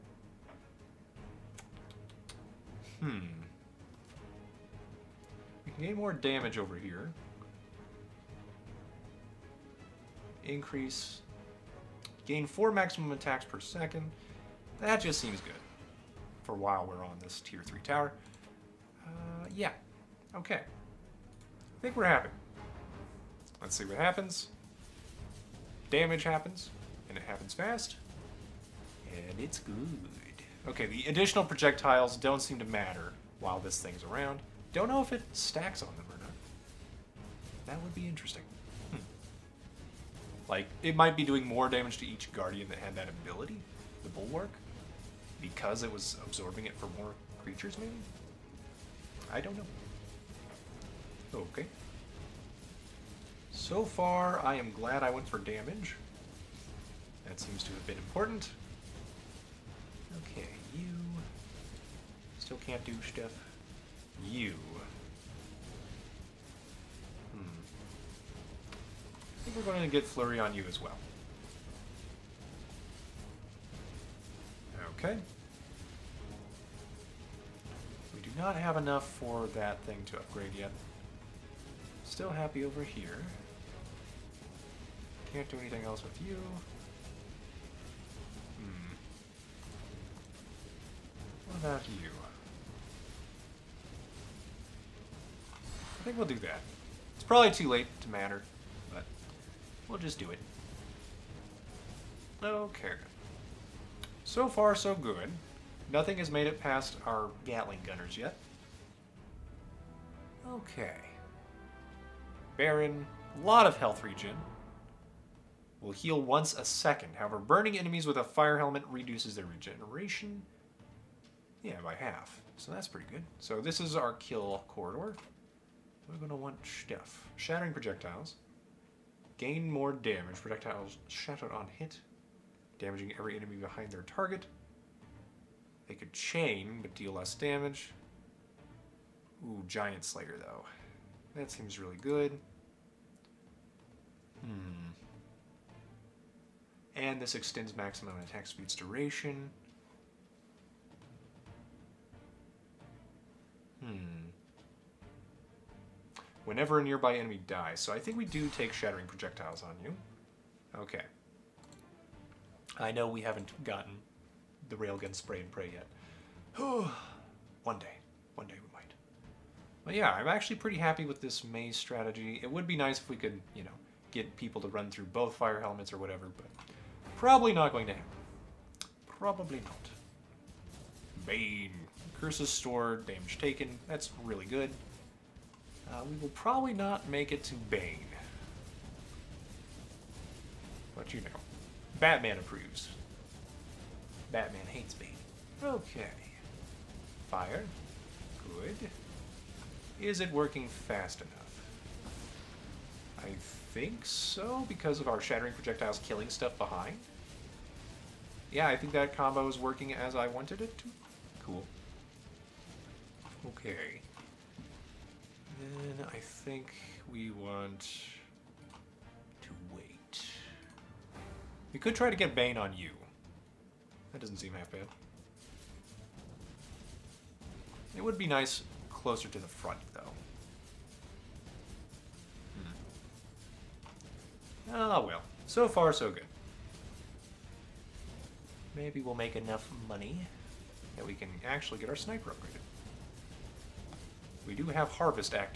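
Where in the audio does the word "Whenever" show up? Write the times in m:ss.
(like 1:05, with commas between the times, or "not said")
2:36.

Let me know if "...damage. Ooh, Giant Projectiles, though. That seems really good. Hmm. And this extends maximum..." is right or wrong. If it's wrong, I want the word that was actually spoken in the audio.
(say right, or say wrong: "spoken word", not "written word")
wrong: "Slayer", not "Projectiles".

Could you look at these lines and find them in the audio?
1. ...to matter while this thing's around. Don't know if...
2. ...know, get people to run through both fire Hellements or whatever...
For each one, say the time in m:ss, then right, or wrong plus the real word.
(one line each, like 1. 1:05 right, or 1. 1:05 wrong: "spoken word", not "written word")
1. 0:32 right
2. 2:53 right.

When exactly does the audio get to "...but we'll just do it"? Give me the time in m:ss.
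1:38.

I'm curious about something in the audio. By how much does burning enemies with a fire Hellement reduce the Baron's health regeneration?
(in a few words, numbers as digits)
by half.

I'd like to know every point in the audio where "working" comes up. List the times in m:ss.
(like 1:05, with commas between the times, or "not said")
3:20, 3:29.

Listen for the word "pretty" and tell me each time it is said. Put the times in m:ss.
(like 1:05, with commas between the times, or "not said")
2:02, 2:50.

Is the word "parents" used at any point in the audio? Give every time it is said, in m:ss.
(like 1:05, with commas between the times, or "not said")
not said.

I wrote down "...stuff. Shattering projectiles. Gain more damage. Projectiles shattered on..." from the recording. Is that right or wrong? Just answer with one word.
right.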